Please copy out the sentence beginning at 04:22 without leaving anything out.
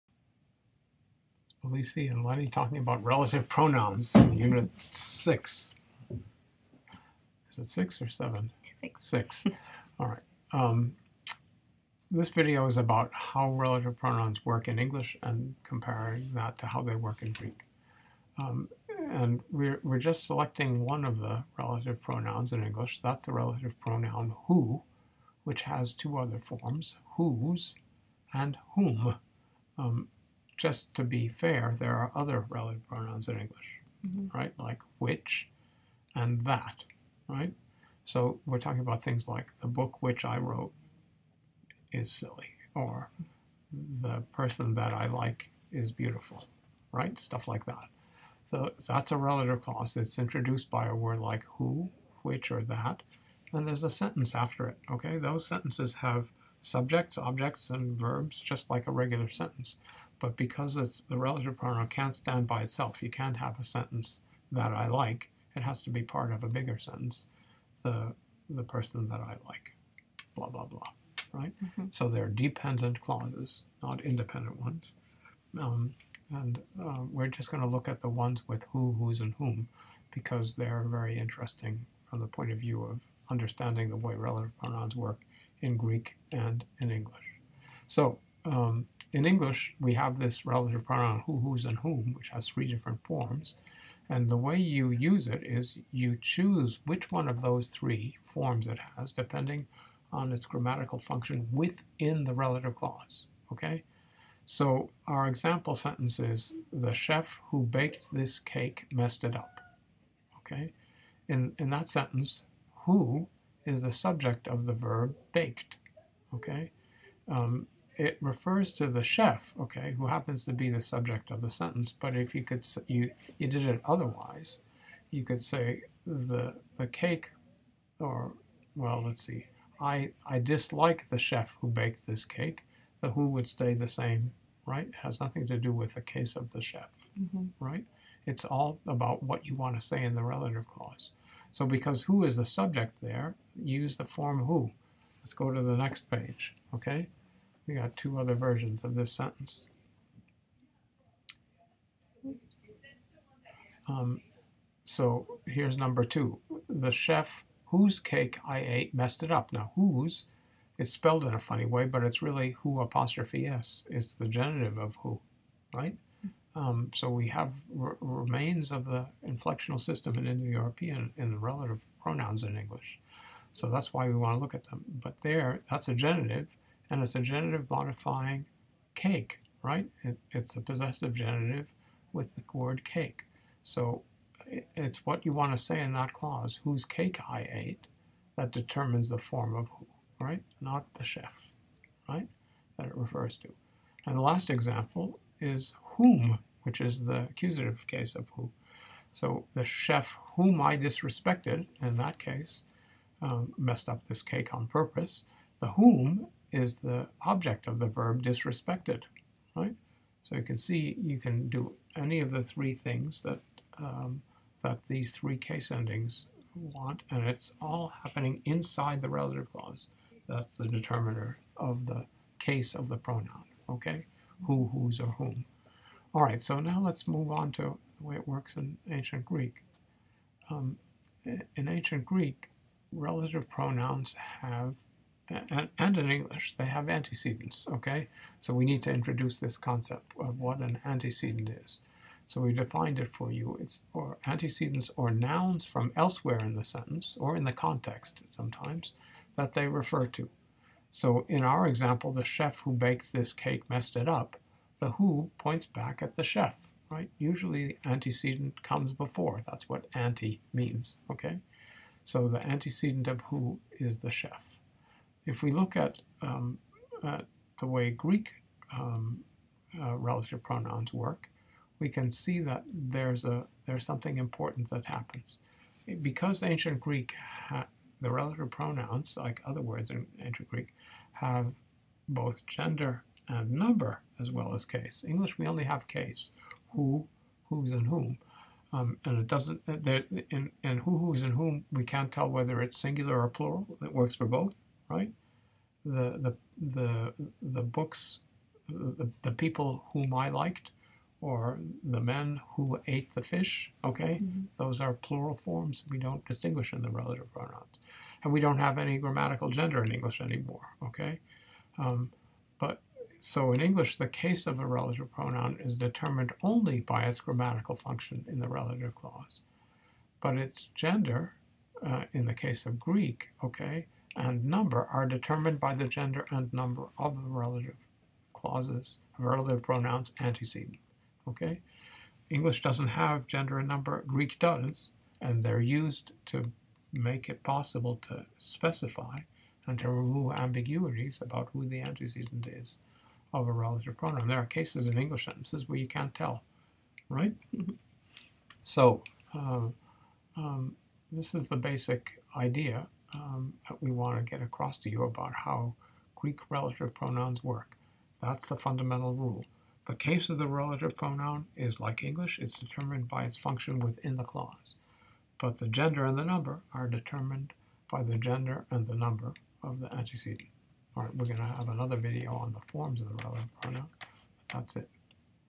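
So the antecedent of who is the chef.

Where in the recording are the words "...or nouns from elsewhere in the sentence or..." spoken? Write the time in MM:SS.
04:04.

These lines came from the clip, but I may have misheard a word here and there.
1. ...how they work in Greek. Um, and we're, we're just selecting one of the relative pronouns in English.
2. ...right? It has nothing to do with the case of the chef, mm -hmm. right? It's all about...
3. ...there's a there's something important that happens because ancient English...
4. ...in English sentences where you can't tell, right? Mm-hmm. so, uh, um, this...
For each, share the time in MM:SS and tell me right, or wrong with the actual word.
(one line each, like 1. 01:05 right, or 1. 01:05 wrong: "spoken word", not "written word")
1. 00:16 right
2. 02:14 right
3. 04:32 wrong: "Greek", not "English"
4. 05:44 right.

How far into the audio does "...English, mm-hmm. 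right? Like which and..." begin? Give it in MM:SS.
00:33.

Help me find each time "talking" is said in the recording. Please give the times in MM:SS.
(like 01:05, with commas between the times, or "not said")
00:02, 00:38.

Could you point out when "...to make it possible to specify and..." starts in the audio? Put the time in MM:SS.
05:36.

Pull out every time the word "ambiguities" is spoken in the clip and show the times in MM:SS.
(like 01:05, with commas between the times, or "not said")
05:40.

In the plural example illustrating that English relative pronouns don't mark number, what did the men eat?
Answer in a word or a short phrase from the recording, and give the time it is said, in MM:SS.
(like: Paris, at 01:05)
the fish, at 05:01.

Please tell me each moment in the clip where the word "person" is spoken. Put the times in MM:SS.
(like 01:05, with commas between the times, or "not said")
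00:44, 01:08.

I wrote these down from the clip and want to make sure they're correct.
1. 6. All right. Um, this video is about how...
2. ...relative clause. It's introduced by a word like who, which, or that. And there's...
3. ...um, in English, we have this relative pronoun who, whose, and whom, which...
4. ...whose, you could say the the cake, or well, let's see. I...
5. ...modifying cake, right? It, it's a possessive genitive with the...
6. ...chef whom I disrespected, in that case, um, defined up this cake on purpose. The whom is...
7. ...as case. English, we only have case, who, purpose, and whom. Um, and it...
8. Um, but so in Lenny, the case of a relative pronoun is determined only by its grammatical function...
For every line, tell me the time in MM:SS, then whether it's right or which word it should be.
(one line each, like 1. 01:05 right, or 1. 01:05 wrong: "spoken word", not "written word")
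1. 00:09 right
2. 00:49 right
3. 01:28 right
4. 02:03 wrong: "otherwise", not "whose"
5. 02:57 right
6. 03:19 wrong: "messed", not "defined"
7. 04:44 wrong: "whose", not "purpose"
8. 05:11 wrong: "English", not "Lenny".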